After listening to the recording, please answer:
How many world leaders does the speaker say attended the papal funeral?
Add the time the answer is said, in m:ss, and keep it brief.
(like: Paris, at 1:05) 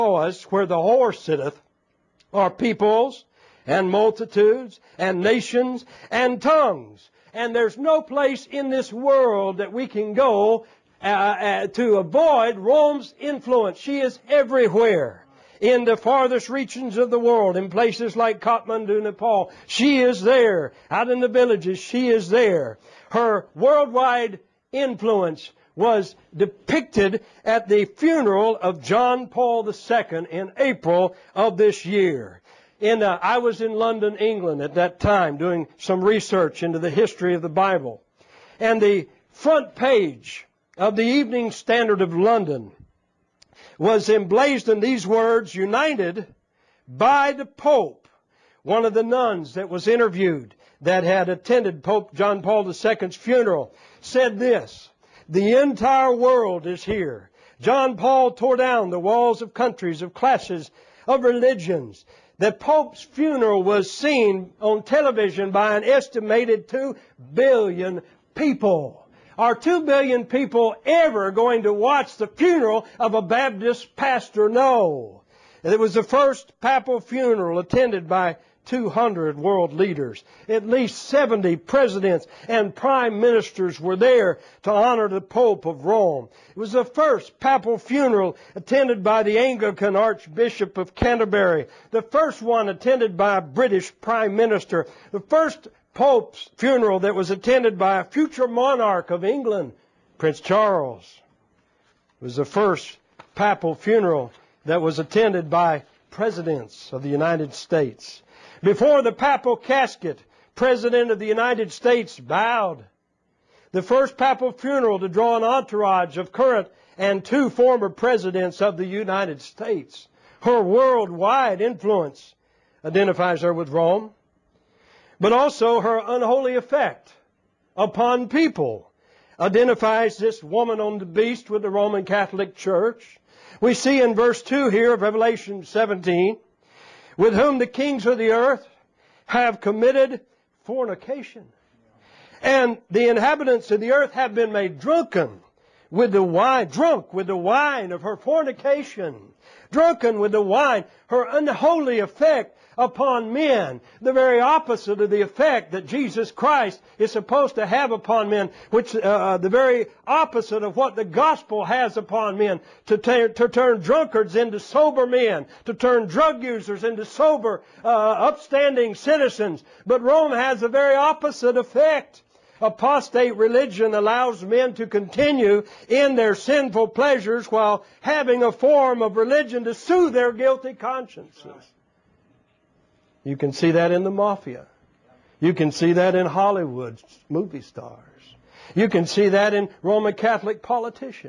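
200, at 1:18.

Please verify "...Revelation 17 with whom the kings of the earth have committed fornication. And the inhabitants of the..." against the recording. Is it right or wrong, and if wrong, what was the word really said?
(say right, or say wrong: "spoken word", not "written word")
right.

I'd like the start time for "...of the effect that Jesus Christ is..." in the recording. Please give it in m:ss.
2:34.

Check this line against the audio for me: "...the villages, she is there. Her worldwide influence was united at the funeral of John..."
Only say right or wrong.
wrong.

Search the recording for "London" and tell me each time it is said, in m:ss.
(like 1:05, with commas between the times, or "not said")
0:33, 0:42.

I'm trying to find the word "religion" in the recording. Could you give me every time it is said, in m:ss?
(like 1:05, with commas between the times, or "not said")
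1:01, 2:53, 2:59.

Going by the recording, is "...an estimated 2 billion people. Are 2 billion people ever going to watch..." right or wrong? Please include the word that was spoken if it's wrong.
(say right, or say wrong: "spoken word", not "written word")
right.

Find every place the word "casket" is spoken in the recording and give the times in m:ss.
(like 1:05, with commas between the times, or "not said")
1:49.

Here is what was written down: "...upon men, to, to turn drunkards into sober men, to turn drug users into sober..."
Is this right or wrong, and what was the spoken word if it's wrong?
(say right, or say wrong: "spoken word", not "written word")
right.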